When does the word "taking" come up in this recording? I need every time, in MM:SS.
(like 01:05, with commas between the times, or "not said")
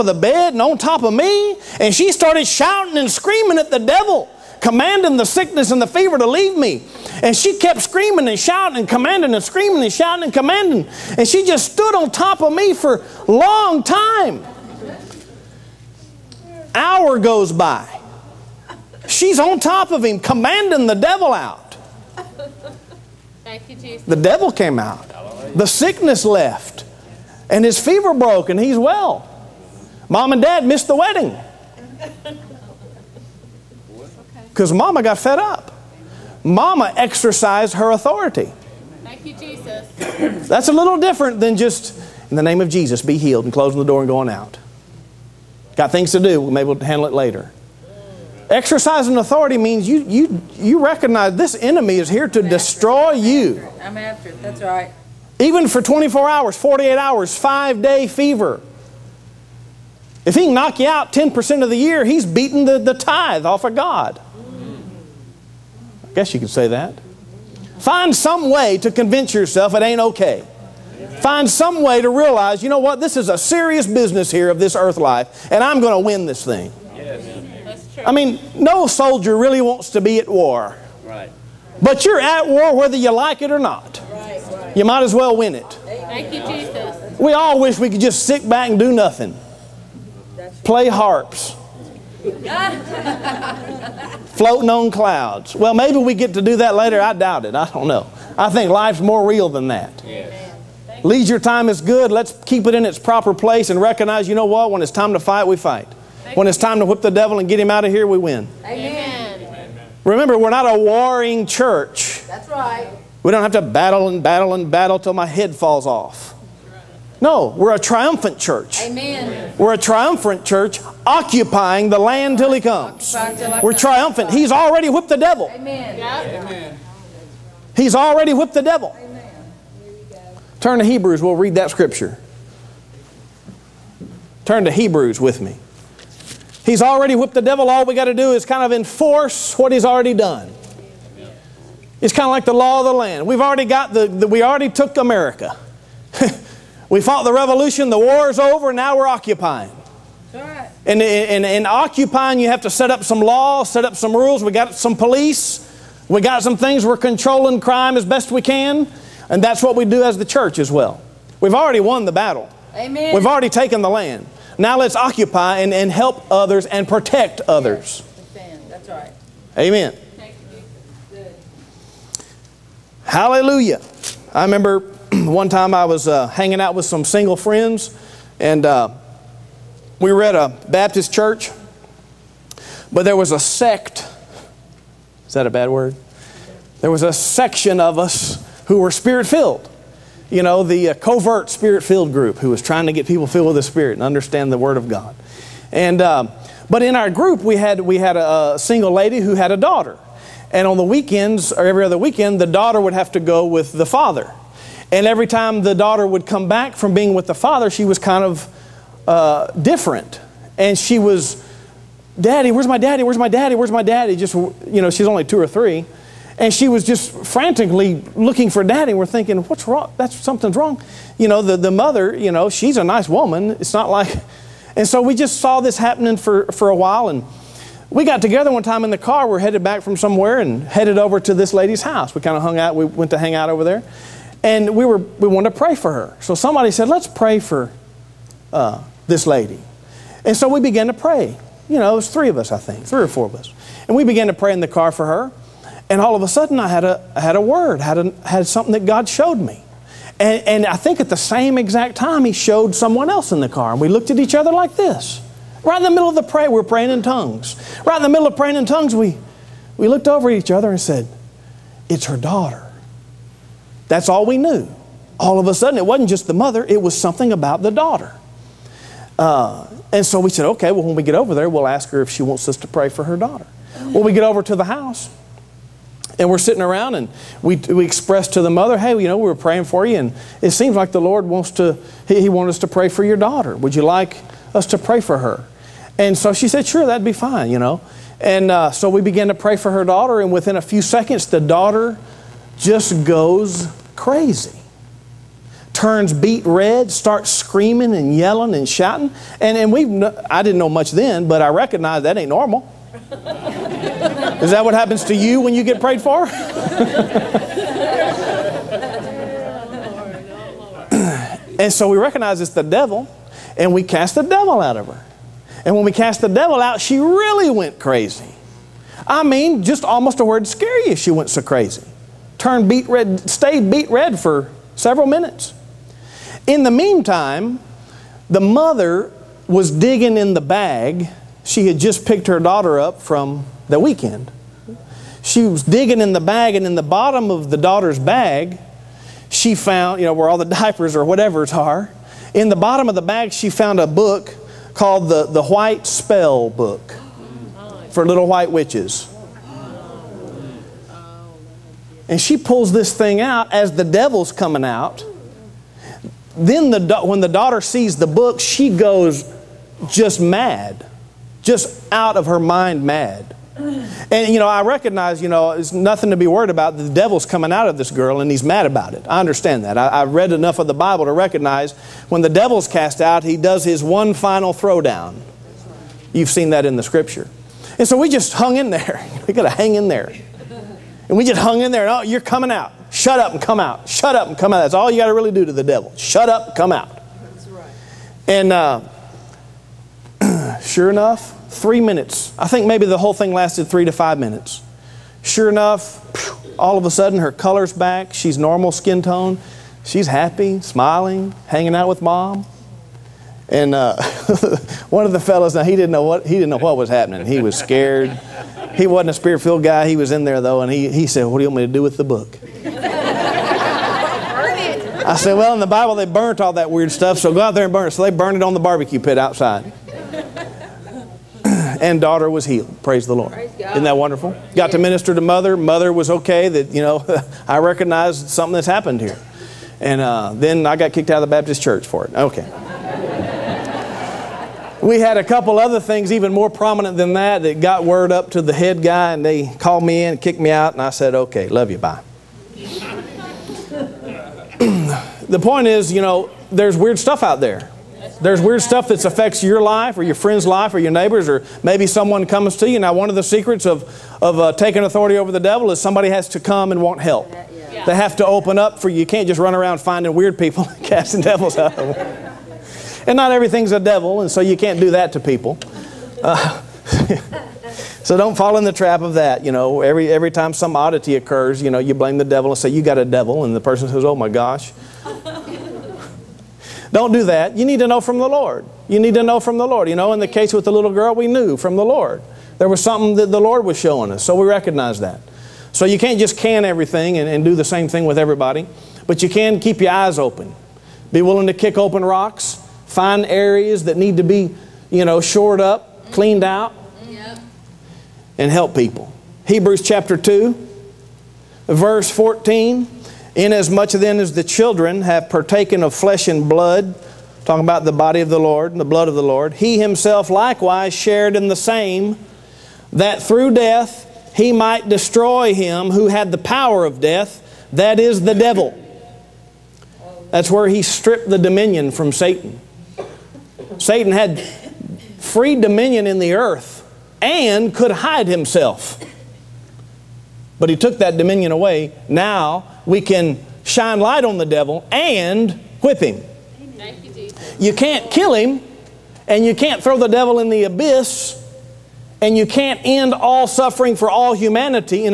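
07:34.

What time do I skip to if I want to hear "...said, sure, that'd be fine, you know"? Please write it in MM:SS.
04:46.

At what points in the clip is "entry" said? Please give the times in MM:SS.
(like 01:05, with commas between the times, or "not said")
not said.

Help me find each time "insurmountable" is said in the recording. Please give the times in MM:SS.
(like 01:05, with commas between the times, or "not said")
not said.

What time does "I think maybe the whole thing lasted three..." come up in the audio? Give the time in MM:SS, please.
06:32.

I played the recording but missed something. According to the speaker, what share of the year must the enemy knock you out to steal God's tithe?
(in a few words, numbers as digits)
10%.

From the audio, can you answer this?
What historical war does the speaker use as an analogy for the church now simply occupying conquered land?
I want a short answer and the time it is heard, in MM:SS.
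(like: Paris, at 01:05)
The revolution, at 02:27.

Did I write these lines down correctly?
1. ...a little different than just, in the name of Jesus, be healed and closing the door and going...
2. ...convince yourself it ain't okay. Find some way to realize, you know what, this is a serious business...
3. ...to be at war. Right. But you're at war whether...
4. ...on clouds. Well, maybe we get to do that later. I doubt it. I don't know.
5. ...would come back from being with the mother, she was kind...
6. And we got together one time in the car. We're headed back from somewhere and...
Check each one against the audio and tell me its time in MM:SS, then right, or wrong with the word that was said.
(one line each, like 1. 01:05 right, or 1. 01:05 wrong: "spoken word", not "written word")
1. 00:40 right
2. 01:08 right
3. 01:19 right
4. 01:34 right
5. 03:26 wrong: "father", not "mother"
6. 03:47 right.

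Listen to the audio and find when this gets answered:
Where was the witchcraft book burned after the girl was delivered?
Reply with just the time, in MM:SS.
06:58.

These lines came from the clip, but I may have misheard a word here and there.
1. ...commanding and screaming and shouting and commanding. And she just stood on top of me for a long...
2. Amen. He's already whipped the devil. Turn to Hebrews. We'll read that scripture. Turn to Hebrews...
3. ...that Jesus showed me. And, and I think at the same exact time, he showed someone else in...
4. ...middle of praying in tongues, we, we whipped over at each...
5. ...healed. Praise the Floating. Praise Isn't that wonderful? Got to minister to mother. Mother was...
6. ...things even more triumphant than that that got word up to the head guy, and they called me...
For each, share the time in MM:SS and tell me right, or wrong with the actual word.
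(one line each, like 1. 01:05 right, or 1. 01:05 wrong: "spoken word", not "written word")
1. 00:08 right
2. 02:05 right
3. 04:08 wrong: "God", not "Jesus"
4. 04:18 wrong: "looked", not "whipped"
5. 07:02 wrong: "Lord", not "Floating"
6. 07:15 wrong: "prominent", not "triumphant".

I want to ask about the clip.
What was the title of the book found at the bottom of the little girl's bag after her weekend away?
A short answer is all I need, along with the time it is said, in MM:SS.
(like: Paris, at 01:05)
White Spell Book, at 05:45.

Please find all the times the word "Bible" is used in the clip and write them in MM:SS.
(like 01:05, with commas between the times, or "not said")
06:10, 06:55.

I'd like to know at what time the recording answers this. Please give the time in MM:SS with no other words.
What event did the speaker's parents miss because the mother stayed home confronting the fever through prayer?
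00:30.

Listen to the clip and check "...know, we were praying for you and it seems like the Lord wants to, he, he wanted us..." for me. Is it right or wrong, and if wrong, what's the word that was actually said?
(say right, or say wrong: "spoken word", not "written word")
right.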